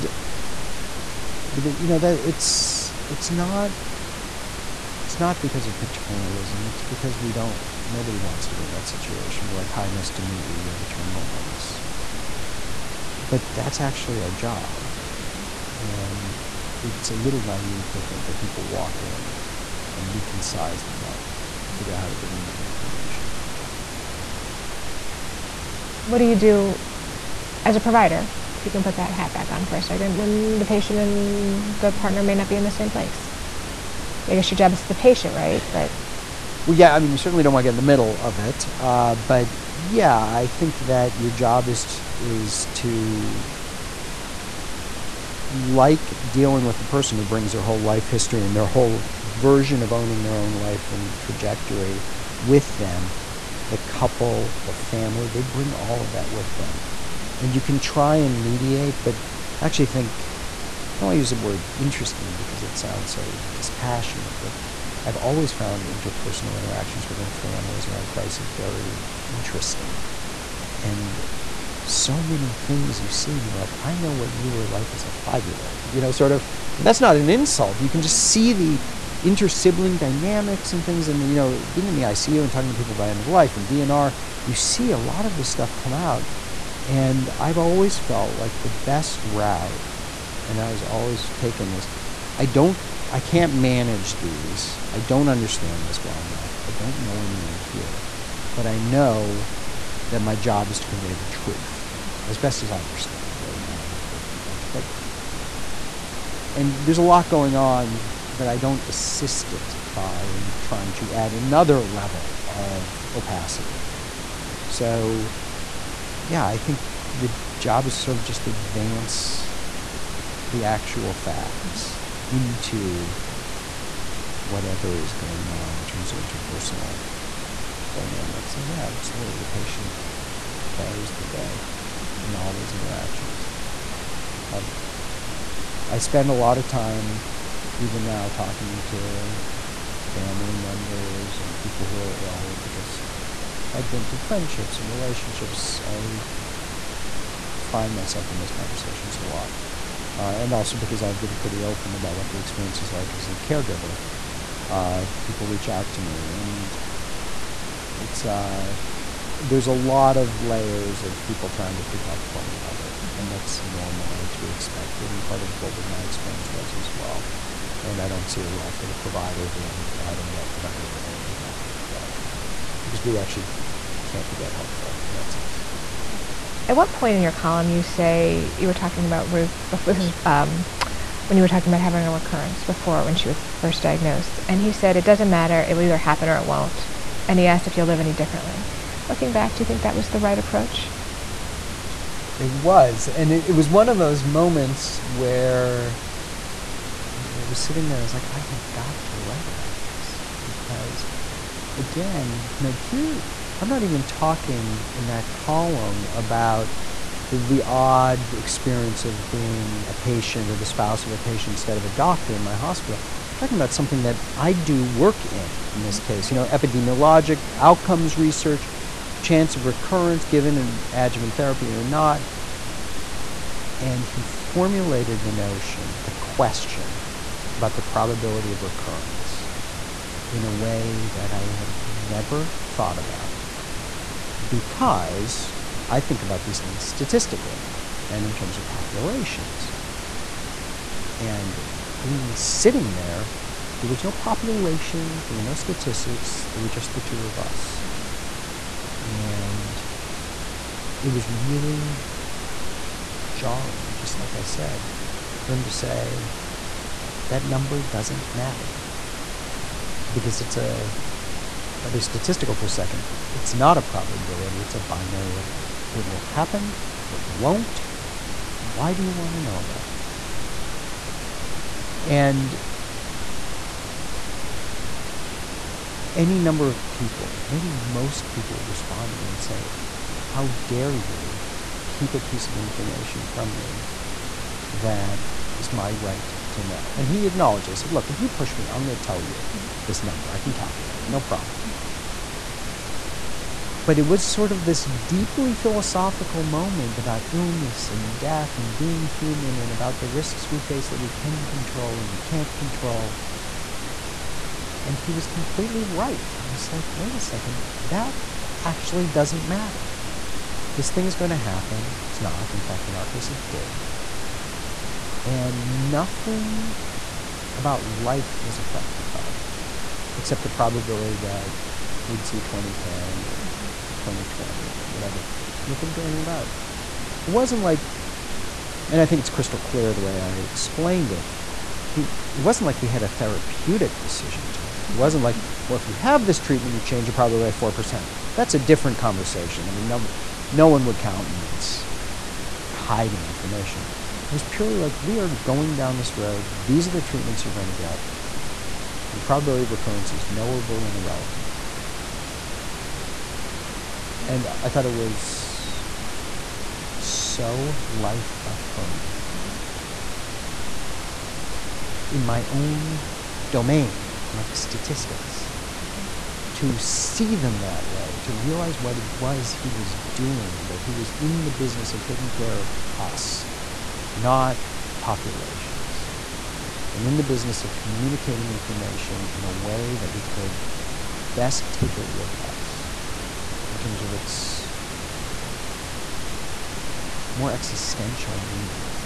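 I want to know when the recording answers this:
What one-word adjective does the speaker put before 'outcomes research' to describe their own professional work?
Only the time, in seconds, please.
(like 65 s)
216 s.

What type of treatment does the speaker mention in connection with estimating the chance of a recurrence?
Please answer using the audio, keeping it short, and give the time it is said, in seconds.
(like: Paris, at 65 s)
Adjuvant therapy, at 220 s.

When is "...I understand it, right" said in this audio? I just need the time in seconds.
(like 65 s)
102 s.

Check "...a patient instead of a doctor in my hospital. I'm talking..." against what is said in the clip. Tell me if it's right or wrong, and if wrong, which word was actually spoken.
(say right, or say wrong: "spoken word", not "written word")
right.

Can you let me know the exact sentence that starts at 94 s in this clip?
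I don't understand this well enough.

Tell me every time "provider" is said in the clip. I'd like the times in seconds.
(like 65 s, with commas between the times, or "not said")
27 s, 168 s.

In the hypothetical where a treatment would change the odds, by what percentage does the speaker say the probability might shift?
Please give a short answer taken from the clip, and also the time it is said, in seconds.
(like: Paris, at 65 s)
4%, at 337 s.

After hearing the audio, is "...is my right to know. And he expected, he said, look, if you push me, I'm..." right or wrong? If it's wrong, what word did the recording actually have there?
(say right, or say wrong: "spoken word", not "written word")
wrong: "acknowledged", not "expected".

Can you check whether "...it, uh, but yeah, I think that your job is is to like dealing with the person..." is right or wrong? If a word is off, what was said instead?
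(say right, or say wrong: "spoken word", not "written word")
right.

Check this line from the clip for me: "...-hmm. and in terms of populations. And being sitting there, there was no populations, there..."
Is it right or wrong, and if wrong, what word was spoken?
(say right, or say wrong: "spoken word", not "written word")
right.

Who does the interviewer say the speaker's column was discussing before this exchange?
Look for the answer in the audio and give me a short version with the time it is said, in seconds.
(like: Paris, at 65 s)
Ruth, at 179 s.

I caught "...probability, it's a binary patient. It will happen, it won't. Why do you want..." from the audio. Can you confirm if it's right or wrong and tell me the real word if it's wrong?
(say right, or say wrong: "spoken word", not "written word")
wrong: "event", not "patient".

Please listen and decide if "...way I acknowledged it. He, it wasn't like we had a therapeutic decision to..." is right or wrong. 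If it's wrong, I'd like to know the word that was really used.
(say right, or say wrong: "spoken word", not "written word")
wrong: "explained", not "acknowledged".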